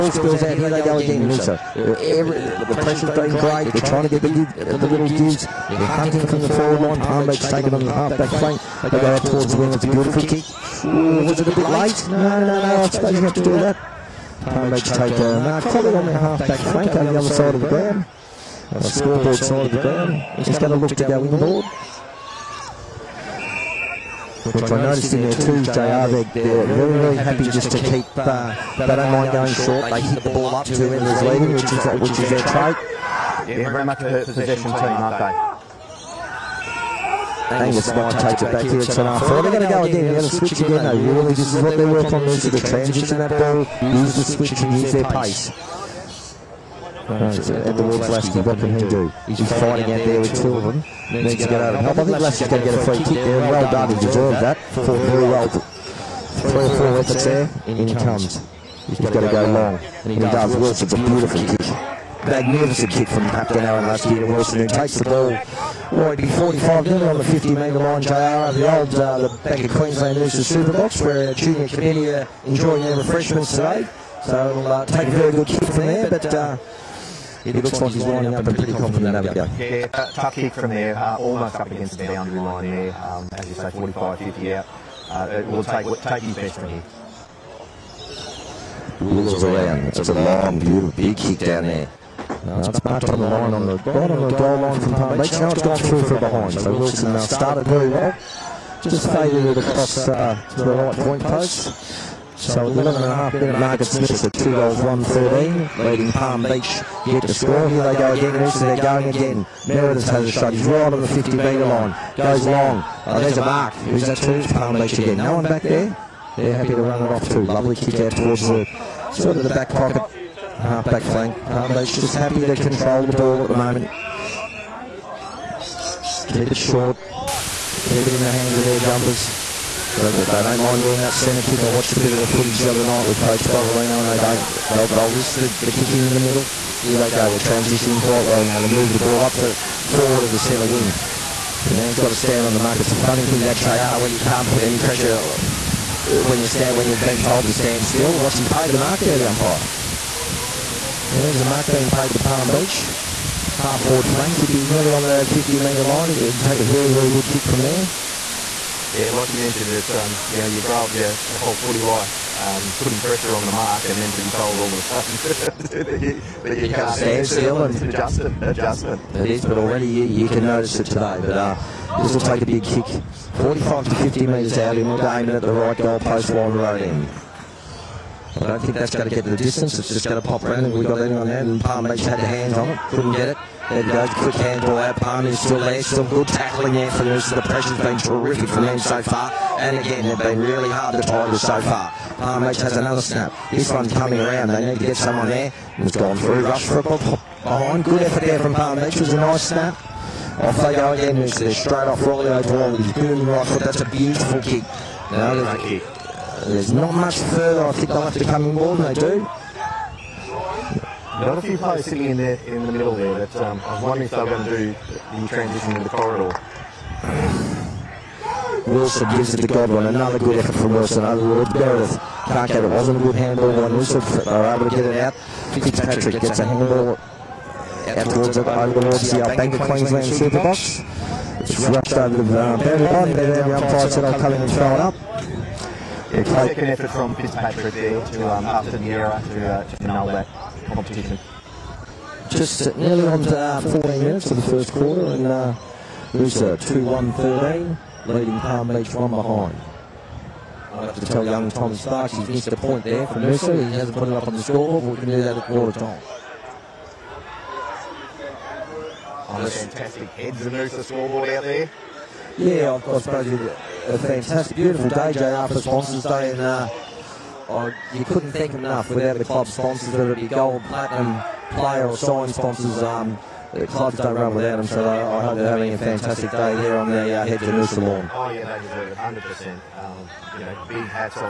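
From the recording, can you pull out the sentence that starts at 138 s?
They move the ball up to forward of the centre wing.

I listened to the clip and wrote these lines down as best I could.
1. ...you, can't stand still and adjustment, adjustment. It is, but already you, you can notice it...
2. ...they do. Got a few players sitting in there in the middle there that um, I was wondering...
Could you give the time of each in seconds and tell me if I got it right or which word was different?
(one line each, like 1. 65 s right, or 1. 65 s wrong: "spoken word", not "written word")
1. 166 s right
2. 208 s right.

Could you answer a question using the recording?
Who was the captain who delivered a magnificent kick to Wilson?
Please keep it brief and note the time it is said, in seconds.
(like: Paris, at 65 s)
Aaron, at 63 s.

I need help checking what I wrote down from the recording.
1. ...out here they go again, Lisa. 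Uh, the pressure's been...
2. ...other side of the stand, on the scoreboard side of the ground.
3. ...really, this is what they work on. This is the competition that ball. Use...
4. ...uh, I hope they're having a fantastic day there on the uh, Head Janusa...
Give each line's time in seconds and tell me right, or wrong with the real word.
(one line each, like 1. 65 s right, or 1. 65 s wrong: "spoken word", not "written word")
1. 0 s right
2. 17 s wrong: "ground", not "stand"
3. 41 s wrong: "transition", not "competition"
4. 275 s right.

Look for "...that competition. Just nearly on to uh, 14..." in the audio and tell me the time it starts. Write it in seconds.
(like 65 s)
240 s.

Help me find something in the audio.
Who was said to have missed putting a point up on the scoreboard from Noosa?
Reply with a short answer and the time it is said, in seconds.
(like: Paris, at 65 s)
Tom Starks, at 251 s.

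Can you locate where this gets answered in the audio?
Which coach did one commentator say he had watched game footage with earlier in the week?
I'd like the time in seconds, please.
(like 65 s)
133 s.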